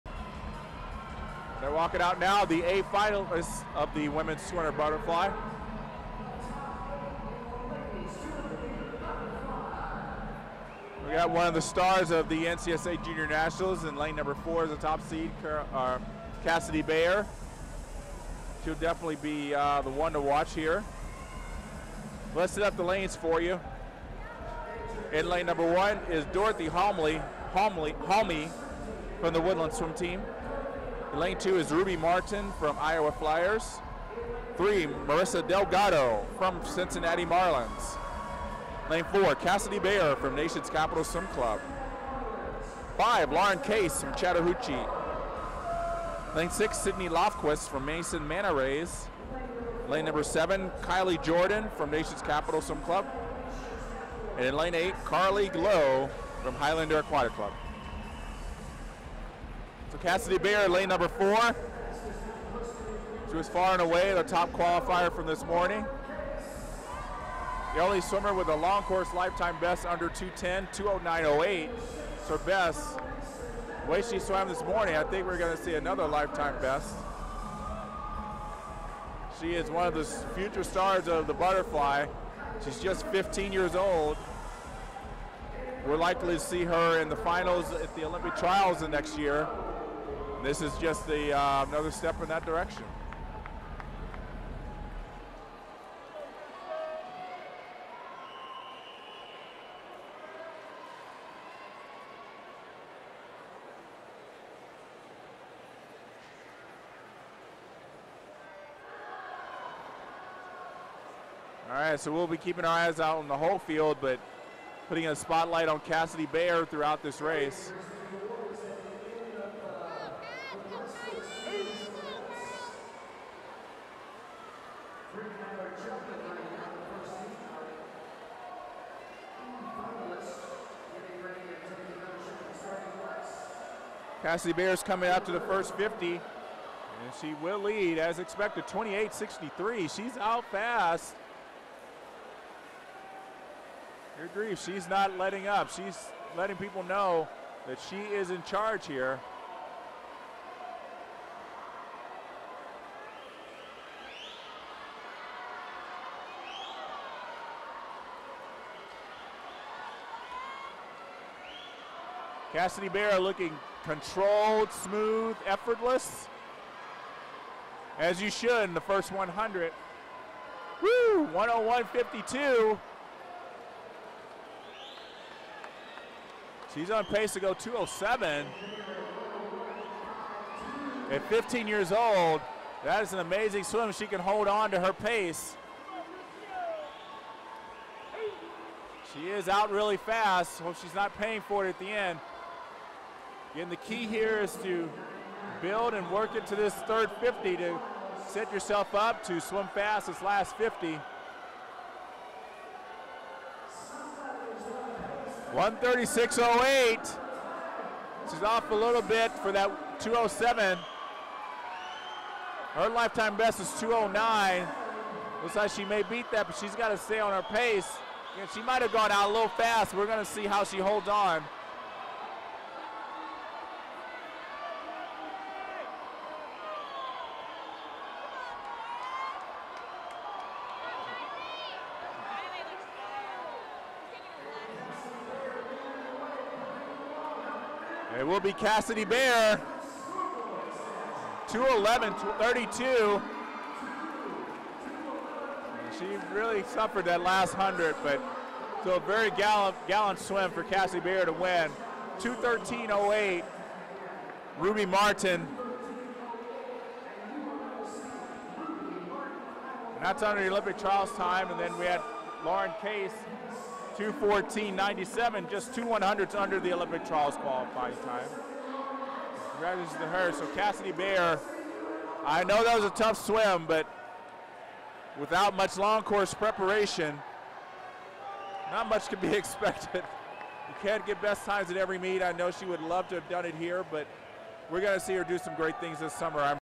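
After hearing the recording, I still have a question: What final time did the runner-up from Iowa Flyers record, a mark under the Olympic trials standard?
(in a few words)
2:13.08.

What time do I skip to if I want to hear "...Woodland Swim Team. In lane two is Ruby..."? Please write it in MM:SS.
00:29.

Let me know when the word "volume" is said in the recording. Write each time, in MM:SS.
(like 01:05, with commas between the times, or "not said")
not said.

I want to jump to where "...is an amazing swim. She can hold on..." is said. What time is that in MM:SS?
03:03.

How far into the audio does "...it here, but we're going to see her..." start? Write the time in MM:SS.
04:43.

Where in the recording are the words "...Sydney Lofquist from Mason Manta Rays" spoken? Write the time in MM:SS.
00:46.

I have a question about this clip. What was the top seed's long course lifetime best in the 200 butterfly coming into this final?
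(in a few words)
2:09.08.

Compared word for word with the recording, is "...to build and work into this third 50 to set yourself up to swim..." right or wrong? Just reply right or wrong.
right.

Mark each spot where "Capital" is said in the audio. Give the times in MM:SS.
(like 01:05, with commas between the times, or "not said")
00:40, 00:52.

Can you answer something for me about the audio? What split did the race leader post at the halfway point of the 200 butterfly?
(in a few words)
1:01.52.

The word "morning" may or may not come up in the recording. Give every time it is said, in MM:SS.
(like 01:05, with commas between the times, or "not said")
01:05, 01:14.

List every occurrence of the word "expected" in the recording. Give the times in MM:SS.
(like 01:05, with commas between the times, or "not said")
02:18, 04:39.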